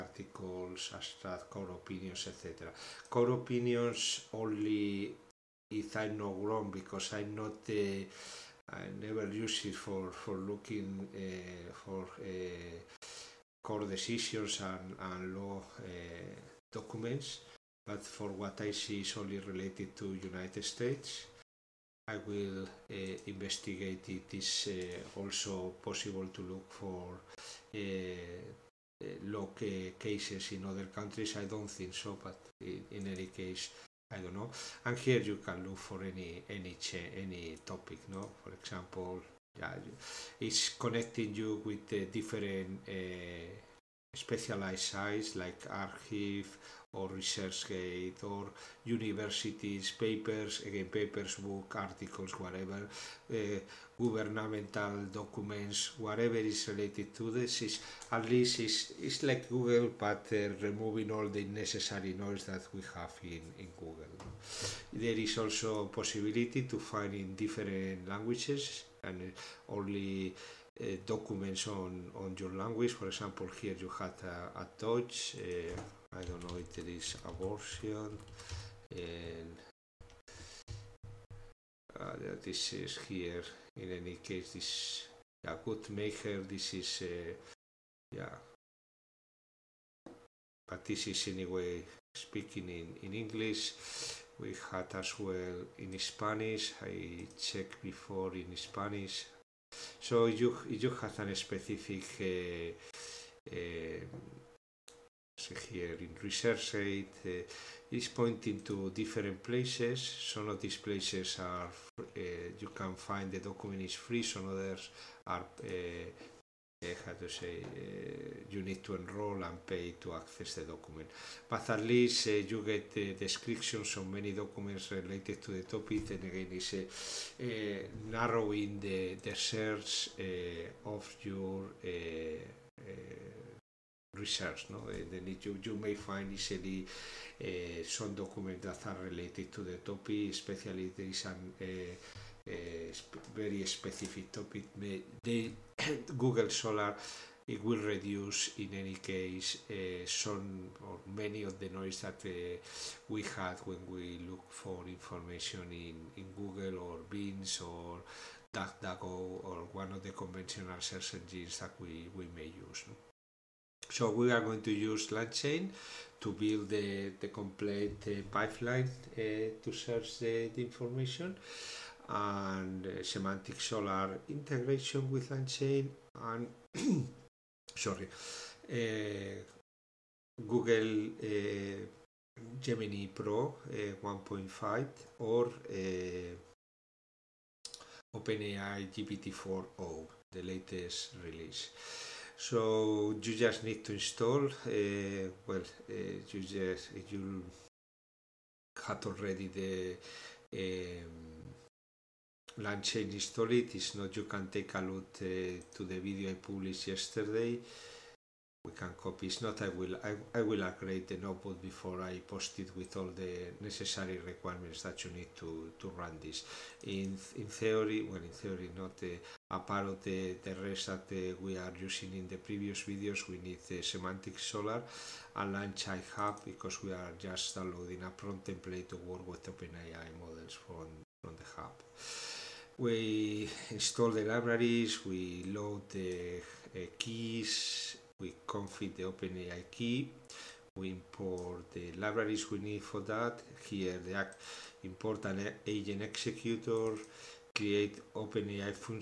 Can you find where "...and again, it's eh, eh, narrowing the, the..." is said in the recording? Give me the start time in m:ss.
2:06.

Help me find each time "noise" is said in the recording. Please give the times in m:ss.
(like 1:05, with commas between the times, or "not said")
1:02, 2:31.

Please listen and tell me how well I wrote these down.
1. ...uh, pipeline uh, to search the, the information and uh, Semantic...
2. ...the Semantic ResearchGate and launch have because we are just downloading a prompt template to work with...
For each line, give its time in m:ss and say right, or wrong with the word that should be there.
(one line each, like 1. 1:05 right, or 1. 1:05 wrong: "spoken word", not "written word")
1. 2:48 right
2. 3:43 wrong: "Scholar", not "ResearchGate".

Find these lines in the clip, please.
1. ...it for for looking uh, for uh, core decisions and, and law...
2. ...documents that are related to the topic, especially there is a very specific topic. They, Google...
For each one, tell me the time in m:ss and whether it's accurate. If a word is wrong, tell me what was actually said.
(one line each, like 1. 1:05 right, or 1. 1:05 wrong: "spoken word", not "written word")
1. 0:09 right
2. 2:18 right.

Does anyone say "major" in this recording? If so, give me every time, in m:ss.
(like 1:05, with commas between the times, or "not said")
not said.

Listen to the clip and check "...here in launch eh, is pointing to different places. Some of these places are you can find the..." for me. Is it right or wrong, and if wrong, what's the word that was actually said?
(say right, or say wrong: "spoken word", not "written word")
wrong: "research", not "launch".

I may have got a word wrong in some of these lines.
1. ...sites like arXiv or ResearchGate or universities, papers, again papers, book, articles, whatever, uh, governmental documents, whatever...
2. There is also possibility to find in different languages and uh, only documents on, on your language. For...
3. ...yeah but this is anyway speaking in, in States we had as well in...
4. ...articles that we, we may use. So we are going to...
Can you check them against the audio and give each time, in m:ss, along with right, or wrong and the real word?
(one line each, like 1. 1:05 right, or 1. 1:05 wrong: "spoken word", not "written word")
1. 0:44 right
2. 1:04 right
3. 1:28 wrong: "English", not "States"
4. 2:41 wrong: "engines", not "articles".